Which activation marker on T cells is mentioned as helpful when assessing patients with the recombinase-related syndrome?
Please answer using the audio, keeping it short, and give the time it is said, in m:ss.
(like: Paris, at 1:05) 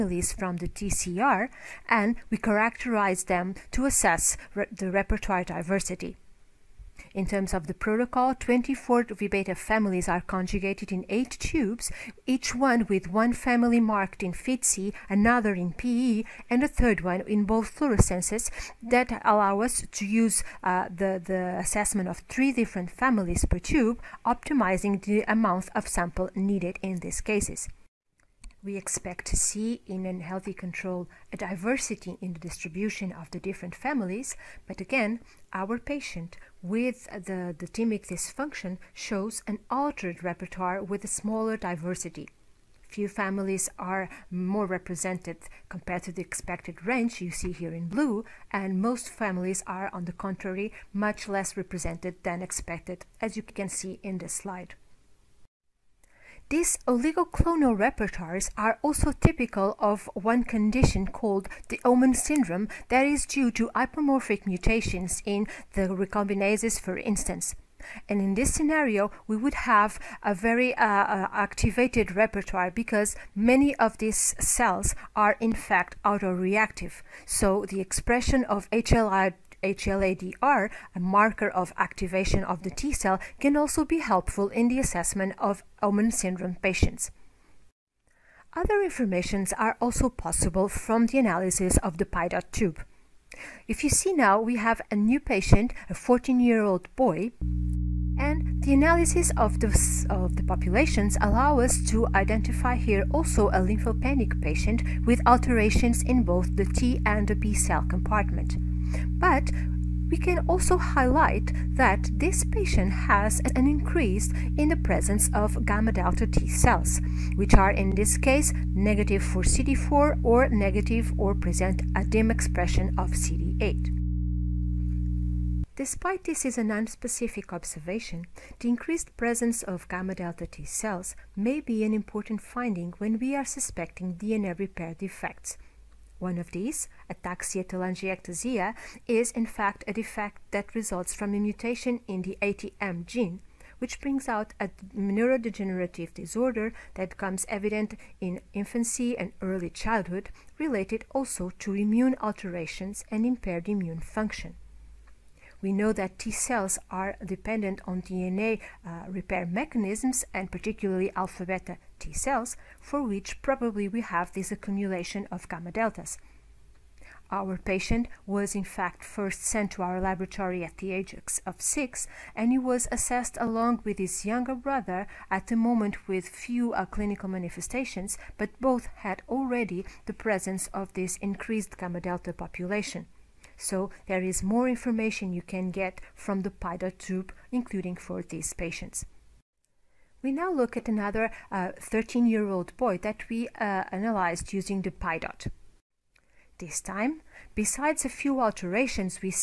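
HLA-DR, at 1:19.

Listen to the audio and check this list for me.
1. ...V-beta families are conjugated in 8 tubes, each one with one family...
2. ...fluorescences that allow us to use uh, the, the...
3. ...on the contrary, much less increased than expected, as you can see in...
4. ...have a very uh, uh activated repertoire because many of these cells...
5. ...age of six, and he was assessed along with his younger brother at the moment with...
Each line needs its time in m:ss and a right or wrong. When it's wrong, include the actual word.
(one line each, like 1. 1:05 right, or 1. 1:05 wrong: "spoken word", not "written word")
1. 0:09 right
2. 0:17 right
3. 0:49 wrong: "represented", not "increased"
4. 1:09 right
5. 2:50 right.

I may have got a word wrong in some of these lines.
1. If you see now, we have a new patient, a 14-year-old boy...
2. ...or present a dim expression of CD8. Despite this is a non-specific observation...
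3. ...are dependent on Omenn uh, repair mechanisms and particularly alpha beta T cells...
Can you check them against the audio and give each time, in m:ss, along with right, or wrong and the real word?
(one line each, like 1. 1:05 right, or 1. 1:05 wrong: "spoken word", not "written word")
1. 1:33 right
2. 2:01 right
3. 2:36 wrong: "DNA", not "Omenn".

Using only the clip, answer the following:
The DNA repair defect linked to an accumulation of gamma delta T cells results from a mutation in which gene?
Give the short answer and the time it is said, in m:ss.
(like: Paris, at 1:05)
ATM, at 2:22.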